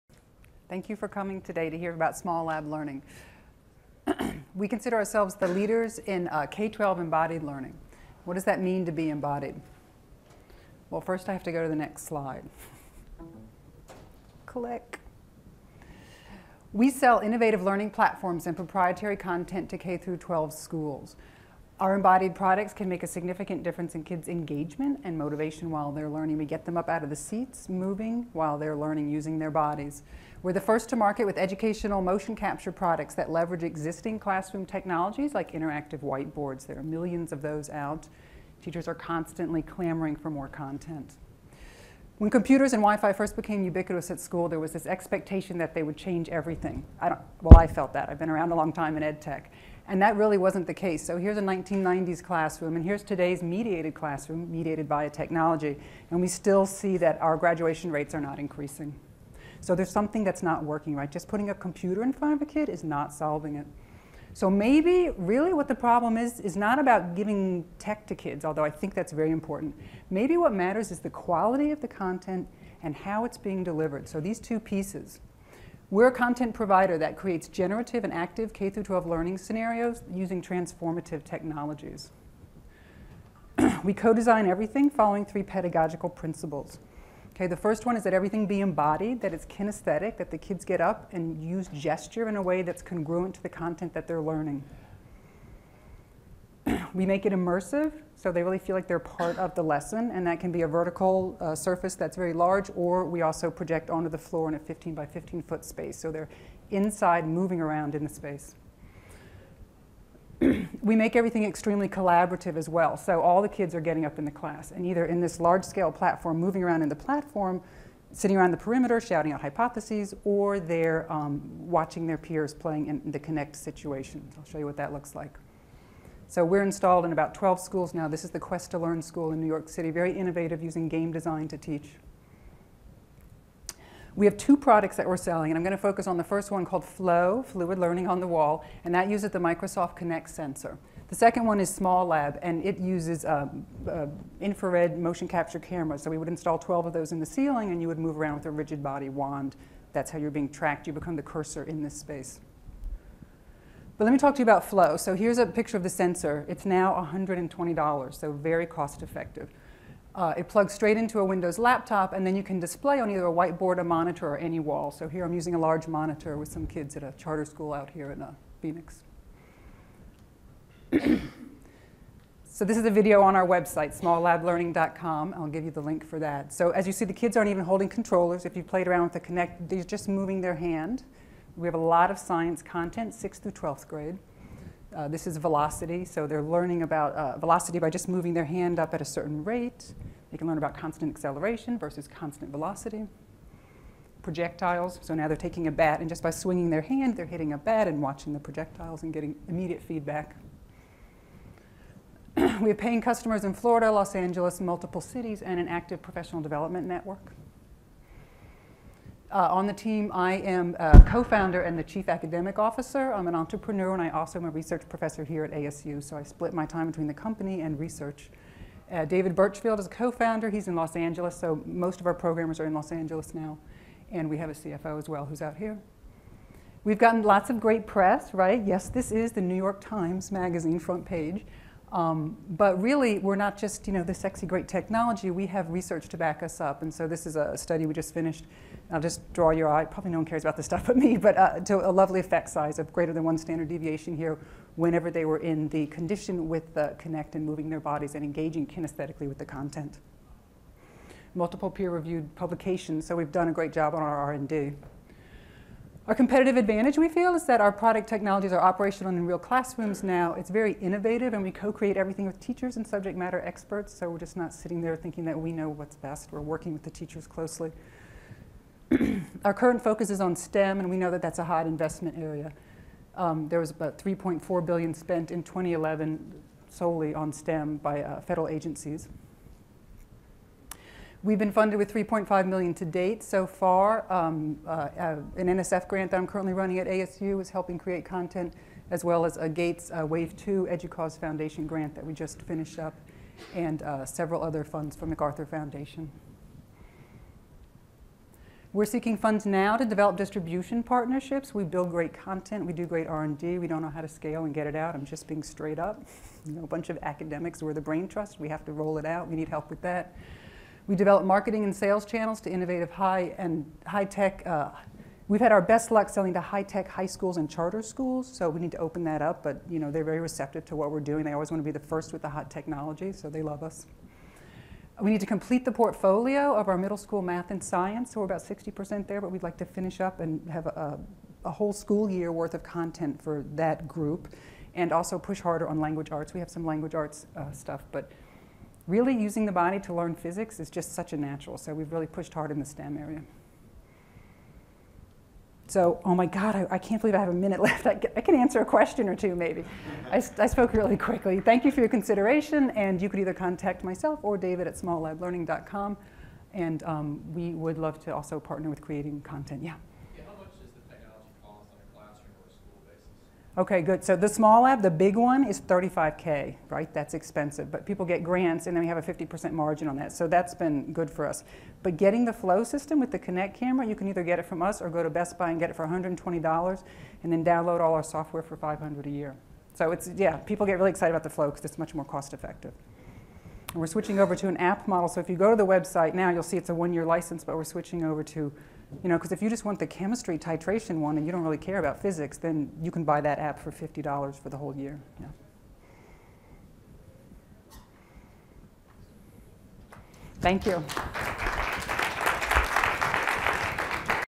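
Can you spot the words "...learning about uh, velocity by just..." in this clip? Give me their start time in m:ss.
3:06.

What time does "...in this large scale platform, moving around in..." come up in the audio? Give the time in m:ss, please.
1:55.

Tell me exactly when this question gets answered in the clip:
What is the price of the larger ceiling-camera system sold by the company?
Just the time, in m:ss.
6:05.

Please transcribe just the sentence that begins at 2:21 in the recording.
The second one is Small Lab, and it uses um, uh, infrared motion capture cameras.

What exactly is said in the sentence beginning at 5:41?
So we've really pushed hard in the STEM area.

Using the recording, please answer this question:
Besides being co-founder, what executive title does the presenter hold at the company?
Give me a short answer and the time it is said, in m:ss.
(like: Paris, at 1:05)
Chief academic officer, at 3:31.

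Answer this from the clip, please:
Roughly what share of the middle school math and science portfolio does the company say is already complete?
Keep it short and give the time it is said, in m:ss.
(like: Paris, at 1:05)
60%, at 5:28.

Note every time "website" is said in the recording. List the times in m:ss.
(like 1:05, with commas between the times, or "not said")
2:53, 6:25.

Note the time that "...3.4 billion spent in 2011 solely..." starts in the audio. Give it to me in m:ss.
4:33.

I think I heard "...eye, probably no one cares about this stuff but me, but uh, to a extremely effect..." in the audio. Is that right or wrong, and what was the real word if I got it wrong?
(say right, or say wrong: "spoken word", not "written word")
wrong: "lovely", not "extremely".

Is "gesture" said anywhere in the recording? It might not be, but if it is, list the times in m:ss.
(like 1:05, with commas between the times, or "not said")
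1:31.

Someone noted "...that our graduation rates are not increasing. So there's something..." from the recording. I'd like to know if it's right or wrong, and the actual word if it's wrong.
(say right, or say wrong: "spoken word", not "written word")
right.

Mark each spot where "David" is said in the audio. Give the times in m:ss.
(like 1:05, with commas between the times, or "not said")
3:39, 5:54.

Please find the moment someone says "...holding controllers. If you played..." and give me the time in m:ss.
2:57.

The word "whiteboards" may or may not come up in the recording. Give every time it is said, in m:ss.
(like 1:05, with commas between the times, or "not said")
0:36, 2:43.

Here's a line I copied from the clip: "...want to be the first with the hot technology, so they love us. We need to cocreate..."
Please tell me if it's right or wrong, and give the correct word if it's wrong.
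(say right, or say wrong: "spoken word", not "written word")
wrong: "complete", not "cocreate".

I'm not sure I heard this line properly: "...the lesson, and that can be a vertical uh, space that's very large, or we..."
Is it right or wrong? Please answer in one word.
wrong.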